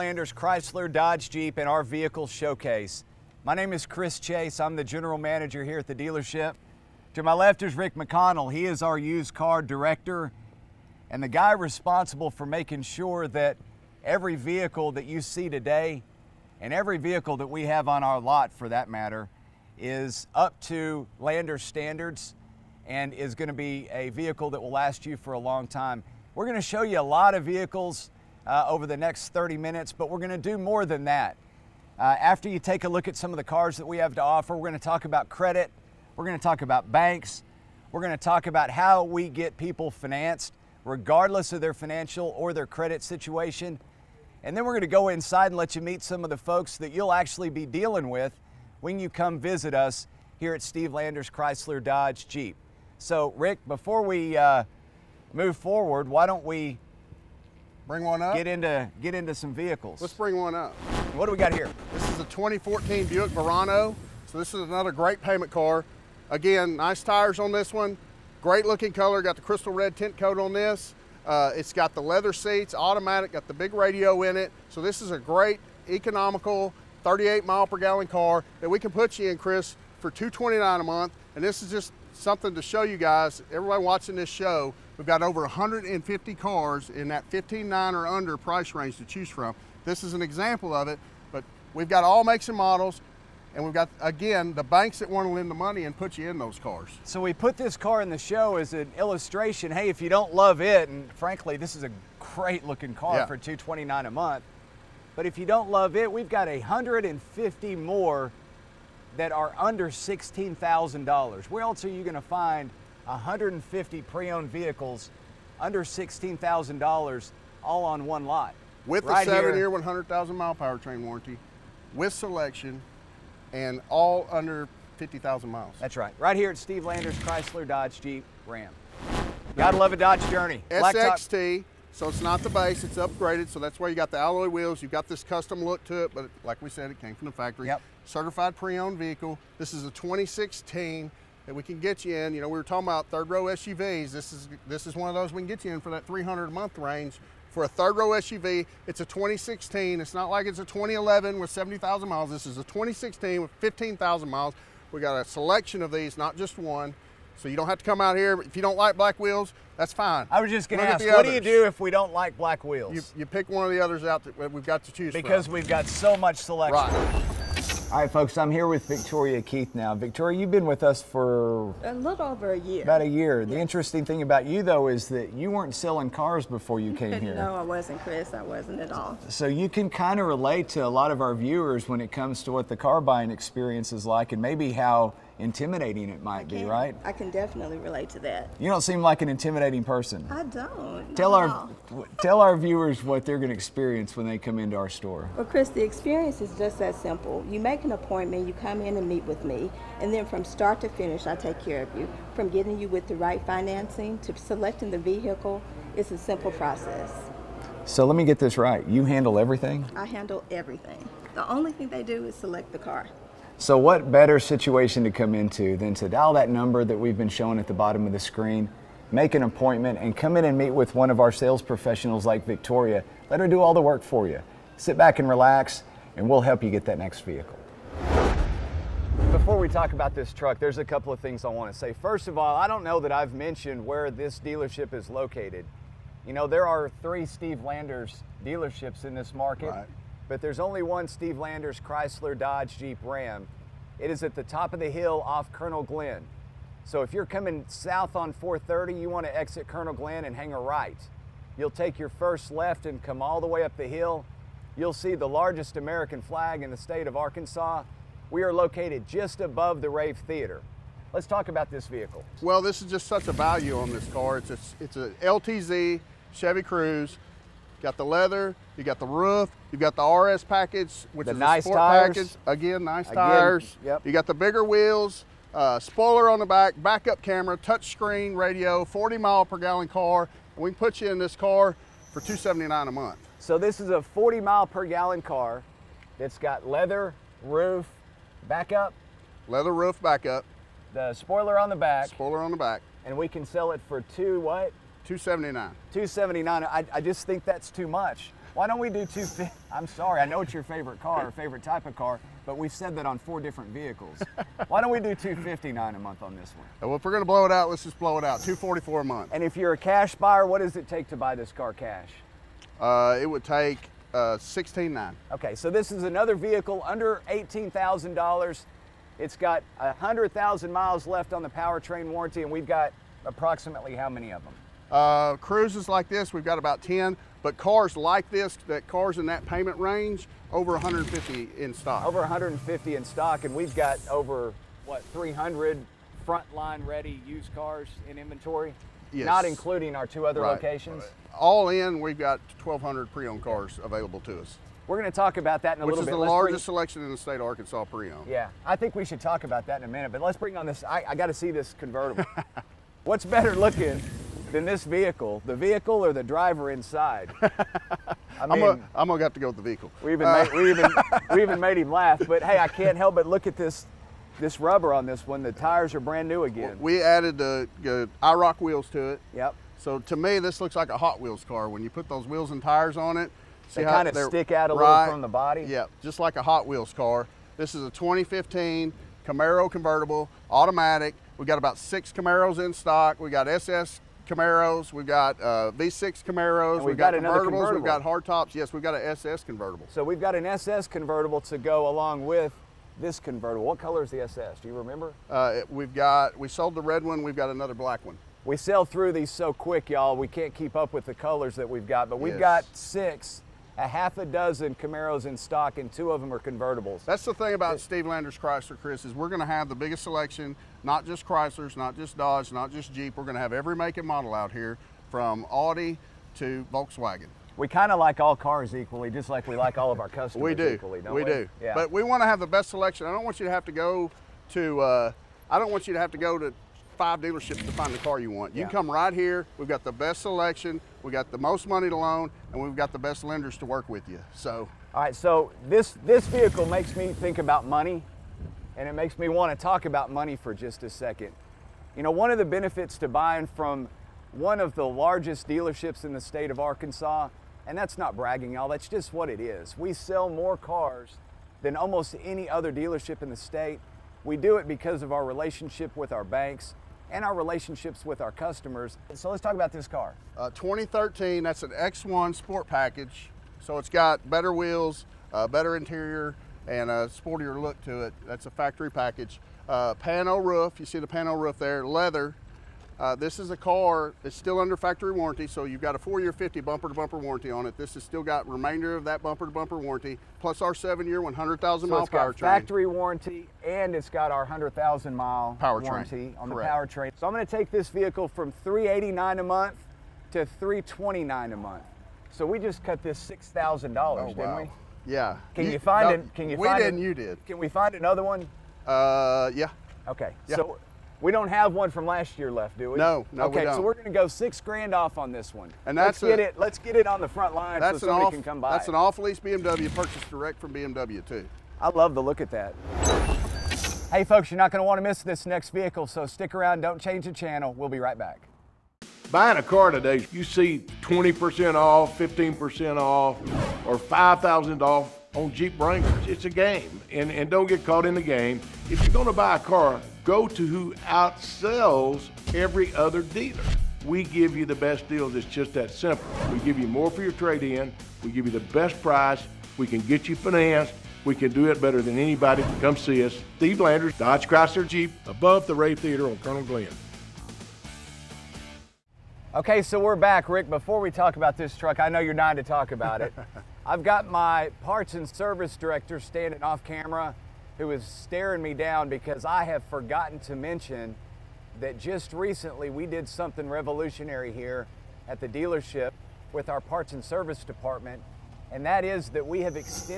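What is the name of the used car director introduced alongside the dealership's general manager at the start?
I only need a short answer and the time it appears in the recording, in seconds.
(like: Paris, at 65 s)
Rick McConnell, at 7 s.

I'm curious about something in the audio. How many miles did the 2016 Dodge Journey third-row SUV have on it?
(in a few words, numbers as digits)
15,000.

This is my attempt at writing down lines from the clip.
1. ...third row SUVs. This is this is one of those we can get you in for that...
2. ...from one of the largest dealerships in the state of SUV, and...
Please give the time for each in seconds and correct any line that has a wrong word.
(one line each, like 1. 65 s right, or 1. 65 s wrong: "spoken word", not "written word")
1. 143 s right
2. 443 s wrong: "Arkansas", not "SUV".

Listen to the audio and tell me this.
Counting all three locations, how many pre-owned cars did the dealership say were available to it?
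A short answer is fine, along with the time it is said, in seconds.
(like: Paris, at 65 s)
1,200, at 342 s.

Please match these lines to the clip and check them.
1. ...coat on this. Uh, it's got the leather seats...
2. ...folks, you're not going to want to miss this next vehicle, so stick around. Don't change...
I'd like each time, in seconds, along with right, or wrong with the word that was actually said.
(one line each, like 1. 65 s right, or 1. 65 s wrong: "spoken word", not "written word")
1. 70 s right
2. 514 s right.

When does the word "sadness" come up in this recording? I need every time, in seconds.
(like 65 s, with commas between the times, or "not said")
not said.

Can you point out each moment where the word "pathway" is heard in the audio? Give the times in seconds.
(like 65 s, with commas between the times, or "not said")
not said.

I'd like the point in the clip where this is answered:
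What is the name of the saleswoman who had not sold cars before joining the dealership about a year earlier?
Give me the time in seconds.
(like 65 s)
168 s.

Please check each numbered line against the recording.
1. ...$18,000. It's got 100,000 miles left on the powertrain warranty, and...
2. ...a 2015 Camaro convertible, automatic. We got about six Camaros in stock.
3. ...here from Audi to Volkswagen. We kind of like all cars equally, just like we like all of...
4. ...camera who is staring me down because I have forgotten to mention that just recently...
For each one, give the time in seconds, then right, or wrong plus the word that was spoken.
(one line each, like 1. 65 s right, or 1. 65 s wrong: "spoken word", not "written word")
1. 317 s right
2. 377 s right
3. 414 s right
4. 556 s right.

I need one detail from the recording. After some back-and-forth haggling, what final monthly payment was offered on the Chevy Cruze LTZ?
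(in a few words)
$244.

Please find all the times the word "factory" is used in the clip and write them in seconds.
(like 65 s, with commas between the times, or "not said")
137 s, 468 s, 474 s, 482 s.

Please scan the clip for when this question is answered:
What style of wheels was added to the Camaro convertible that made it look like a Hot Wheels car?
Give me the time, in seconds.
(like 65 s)
368 s.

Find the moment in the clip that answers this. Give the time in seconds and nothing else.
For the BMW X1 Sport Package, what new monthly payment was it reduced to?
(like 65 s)
490 s.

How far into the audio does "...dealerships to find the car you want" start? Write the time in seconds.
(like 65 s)
427 s.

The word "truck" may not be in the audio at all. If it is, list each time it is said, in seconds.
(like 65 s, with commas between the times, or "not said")
230 s, 551 s.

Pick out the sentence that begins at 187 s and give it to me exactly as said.
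I can definitely relate to that.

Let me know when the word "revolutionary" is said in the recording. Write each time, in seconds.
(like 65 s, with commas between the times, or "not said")
563 s.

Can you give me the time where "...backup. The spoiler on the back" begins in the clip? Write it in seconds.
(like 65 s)
290 s.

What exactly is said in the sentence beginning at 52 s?
So, Rick, before we uh, move forward, why don't we bring one up?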